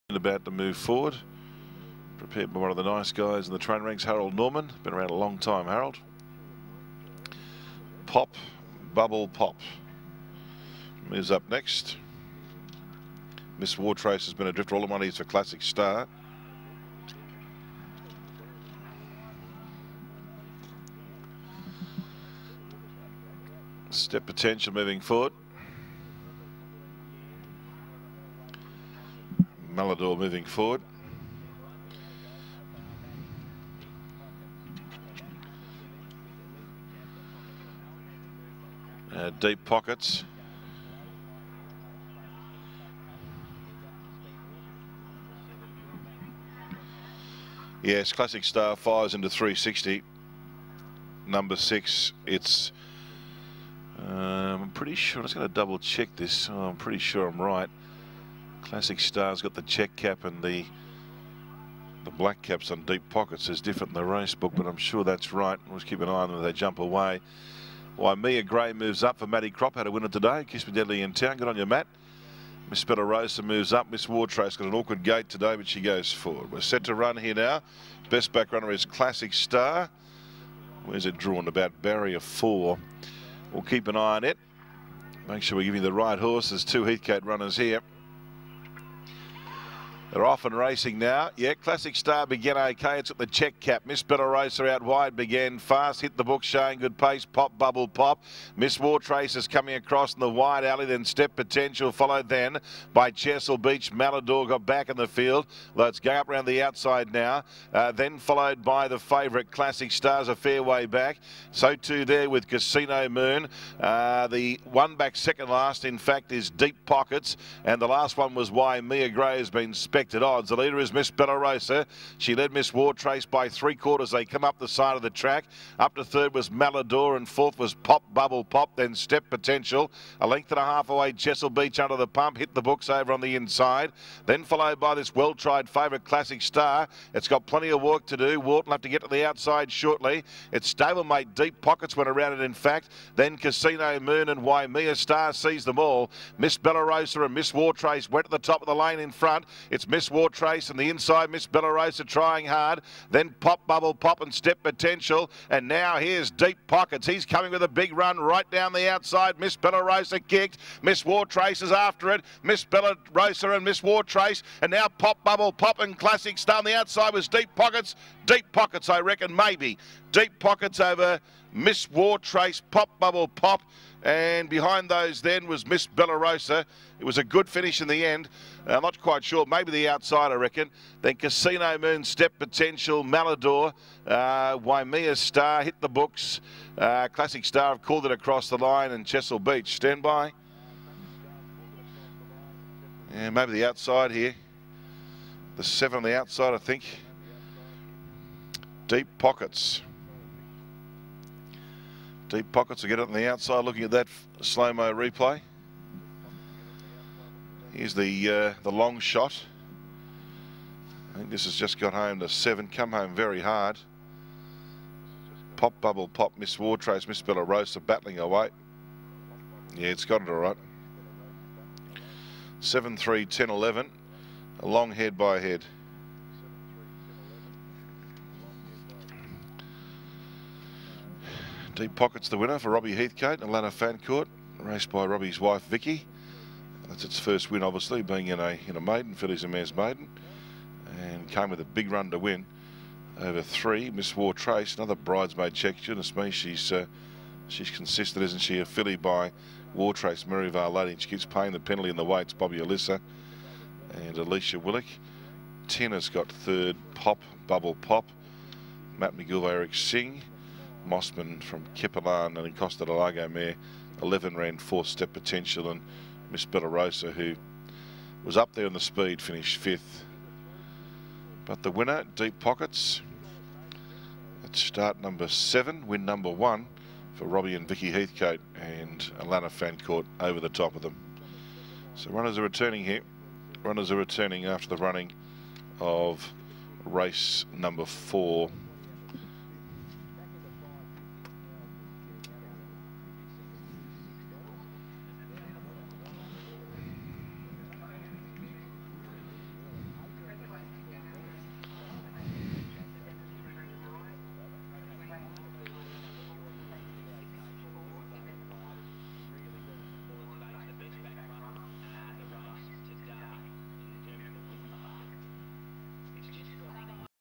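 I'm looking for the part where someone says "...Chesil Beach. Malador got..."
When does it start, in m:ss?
1:43.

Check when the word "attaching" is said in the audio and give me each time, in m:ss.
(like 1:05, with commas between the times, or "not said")
not said.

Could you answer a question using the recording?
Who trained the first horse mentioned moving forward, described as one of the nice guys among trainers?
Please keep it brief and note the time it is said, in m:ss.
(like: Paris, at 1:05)
Harold Norman, at 0:04.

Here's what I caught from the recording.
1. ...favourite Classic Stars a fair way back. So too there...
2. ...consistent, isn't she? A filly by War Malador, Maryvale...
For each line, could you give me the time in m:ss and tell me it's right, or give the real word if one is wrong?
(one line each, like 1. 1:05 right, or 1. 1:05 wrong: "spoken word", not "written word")
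1. 1:48 right
2. 4:07 wrong: "Trace", not "Malador".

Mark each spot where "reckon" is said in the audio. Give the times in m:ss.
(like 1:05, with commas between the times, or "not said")
2:49, 3:00.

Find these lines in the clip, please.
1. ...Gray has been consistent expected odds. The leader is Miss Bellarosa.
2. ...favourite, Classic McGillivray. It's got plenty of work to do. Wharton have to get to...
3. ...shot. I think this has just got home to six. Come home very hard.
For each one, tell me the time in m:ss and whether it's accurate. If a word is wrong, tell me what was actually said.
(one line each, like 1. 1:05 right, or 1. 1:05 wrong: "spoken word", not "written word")
1. 1:59 wrong: "spent", not "consistent"
2. 2:15 wrong: "Star", not "McGillivray"
3. 3:29 wrong: "seven", not "six".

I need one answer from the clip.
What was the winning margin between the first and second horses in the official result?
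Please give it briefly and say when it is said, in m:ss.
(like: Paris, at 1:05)
A long head, at 3:44.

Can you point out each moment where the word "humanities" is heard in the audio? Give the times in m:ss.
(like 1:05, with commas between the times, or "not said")
not said.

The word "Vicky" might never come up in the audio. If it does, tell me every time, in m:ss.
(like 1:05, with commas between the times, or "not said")
3:55, 4:37.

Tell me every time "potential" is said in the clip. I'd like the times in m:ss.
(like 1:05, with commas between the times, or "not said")
0:24, 1:41, 2:09, 2:34, 3:02, 4:25.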